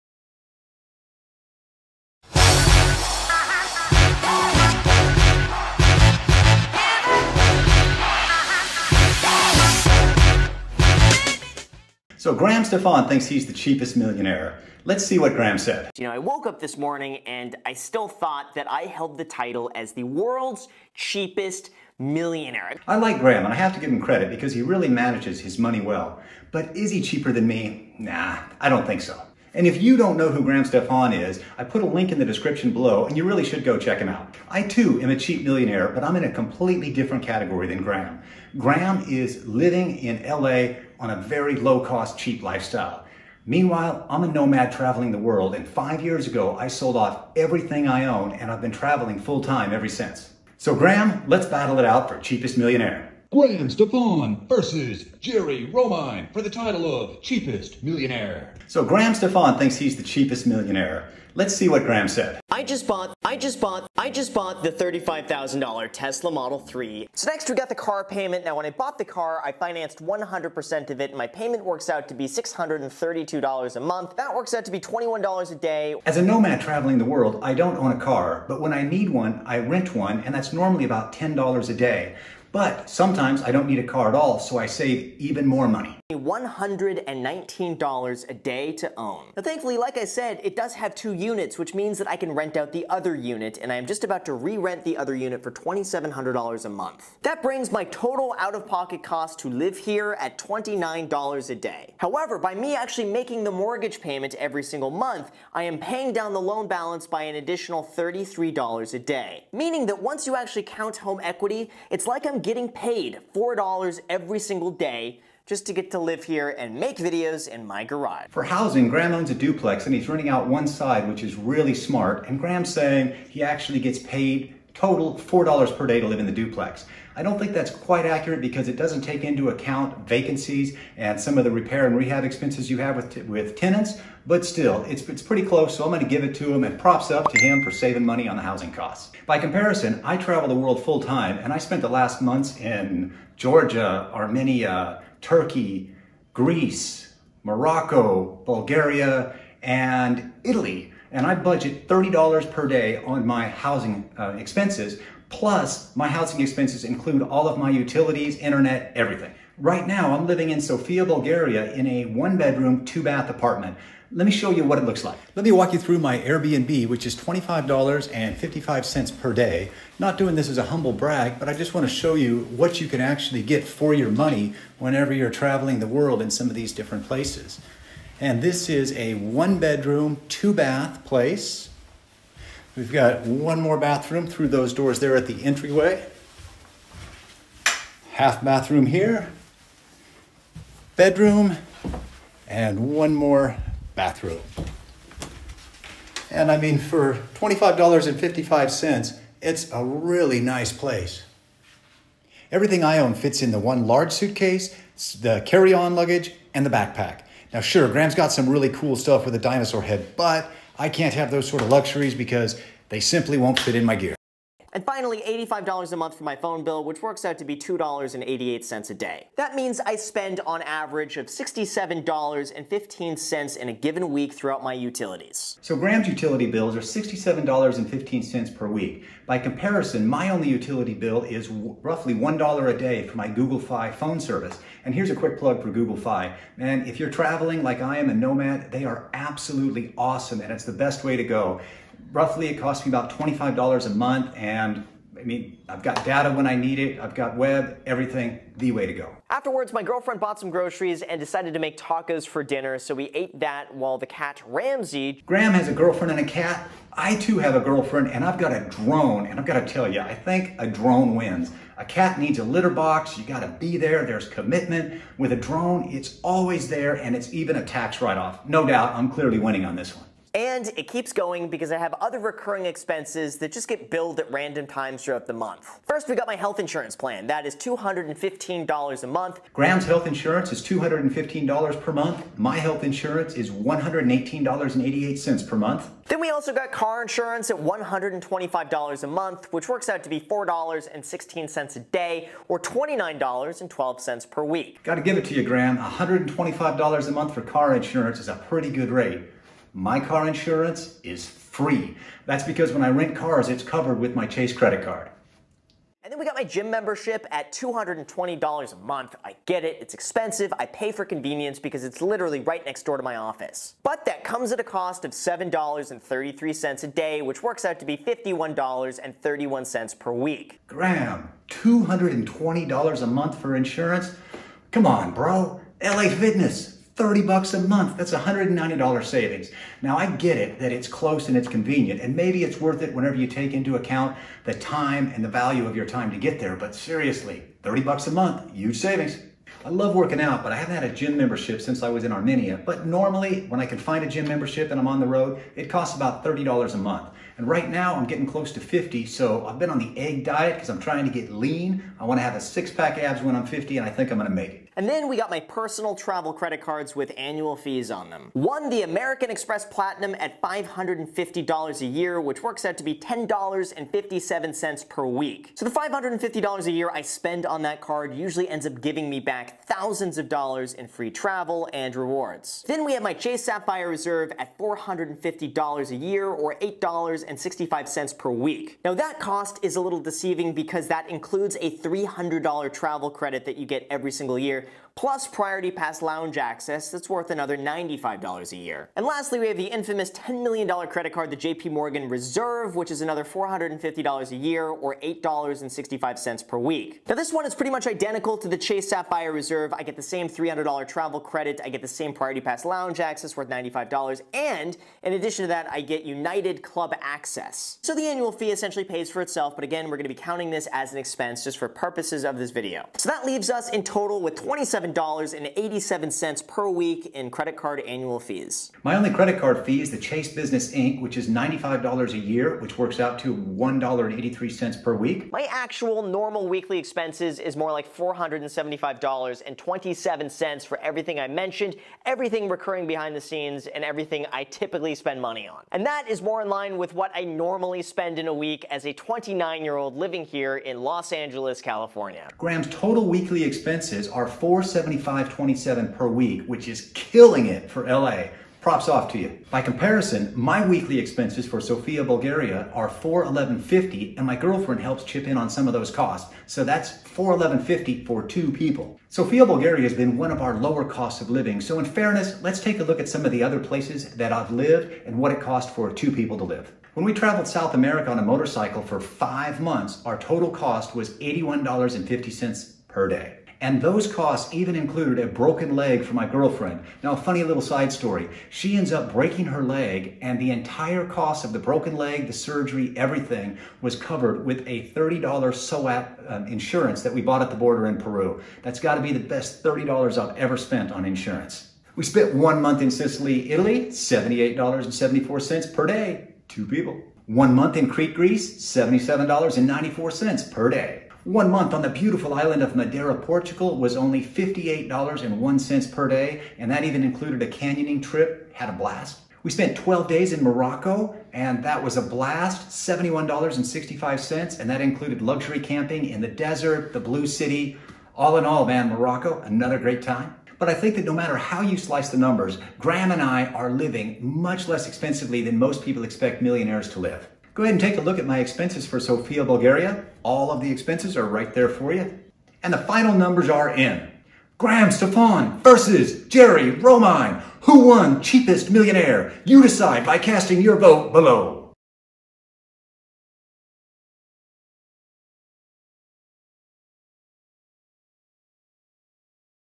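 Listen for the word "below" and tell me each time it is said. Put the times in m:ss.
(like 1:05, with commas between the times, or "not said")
0:32, 9:01.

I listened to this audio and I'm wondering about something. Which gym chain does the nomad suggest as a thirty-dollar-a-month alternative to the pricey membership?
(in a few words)
LA Fitness.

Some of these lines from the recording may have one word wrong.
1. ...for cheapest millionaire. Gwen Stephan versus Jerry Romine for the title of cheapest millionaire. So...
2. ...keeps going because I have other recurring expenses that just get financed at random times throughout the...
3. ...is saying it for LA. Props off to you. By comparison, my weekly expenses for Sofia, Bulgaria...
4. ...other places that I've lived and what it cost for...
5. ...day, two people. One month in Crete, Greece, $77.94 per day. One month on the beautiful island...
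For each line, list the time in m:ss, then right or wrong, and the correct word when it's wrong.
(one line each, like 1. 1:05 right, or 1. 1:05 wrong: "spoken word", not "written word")
1. 0:52 right
2. 4:30 wrong: "billed", not "financed"
3. 7:26 wrong: "killing", not "saying"
4. 7:43 right
5. 8:15 right.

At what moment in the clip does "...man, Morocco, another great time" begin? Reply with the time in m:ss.
8:38.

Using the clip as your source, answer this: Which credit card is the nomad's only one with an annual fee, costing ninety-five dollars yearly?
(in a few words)
Chase Business Ink.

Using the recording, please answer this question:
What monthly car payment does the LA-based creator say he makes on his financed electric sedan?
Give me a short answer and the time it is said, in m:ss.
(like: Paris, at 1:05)
$632, at 1:12.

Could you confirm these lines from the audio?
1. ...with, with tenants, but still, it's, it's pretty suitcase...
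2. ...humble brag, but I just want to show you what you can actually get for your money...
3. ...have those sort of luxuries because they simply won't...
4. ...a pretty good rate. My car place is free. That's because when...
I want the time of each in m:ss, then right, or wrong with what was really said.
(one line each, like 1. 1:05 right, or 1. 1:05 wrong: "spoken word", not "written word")
1. 2:12 wrong: "close", not "suitcase"
2. 2:50 right
3. 3:31 right
4. 4:58 wrong: "insurance", not "place".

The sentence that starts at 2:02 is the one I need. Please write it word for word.
And Graham's saying he actually gets paid total $4 per day to live in the duplex.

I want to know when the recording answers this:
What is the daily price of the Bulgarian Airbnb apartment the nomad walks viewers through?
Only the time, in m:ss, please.
2:47.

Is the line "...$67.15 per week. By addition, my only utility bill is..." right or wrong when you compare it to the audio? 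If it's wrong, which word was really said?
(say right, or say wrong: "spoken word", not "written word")
wrong: "comparison", not "addition".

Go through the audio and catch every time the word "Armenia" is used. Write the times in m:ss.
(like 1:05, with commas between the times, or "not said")
2:24, 5:42.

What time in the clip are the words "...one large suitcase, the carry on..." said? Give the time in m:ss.
3:23.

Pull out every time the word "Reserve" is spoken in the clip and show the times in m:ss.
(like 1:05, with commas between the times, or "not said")
6:13, 6:32, 6:39.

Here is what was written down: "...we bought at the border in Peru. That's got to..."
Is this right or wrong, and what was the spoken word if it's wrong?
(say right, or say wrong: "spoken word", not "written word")
right.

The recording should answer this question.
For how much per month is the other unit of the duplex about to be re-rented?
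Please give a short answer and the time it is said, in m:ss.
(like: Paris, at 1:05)
$2,700, at 1:35.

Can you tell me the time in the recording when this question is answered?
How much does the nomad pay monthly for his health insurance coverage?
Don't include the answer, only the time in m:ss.
4:43.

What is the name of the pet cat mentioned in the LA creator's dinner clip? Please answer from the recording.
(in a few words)
Ramsey.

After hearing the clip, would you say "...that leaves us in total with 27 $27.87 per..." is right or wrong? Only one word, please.
right.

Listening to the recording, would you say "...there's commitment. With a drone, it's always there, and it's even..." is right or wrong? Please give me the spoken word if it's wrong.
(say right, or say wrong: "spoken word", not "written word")
right.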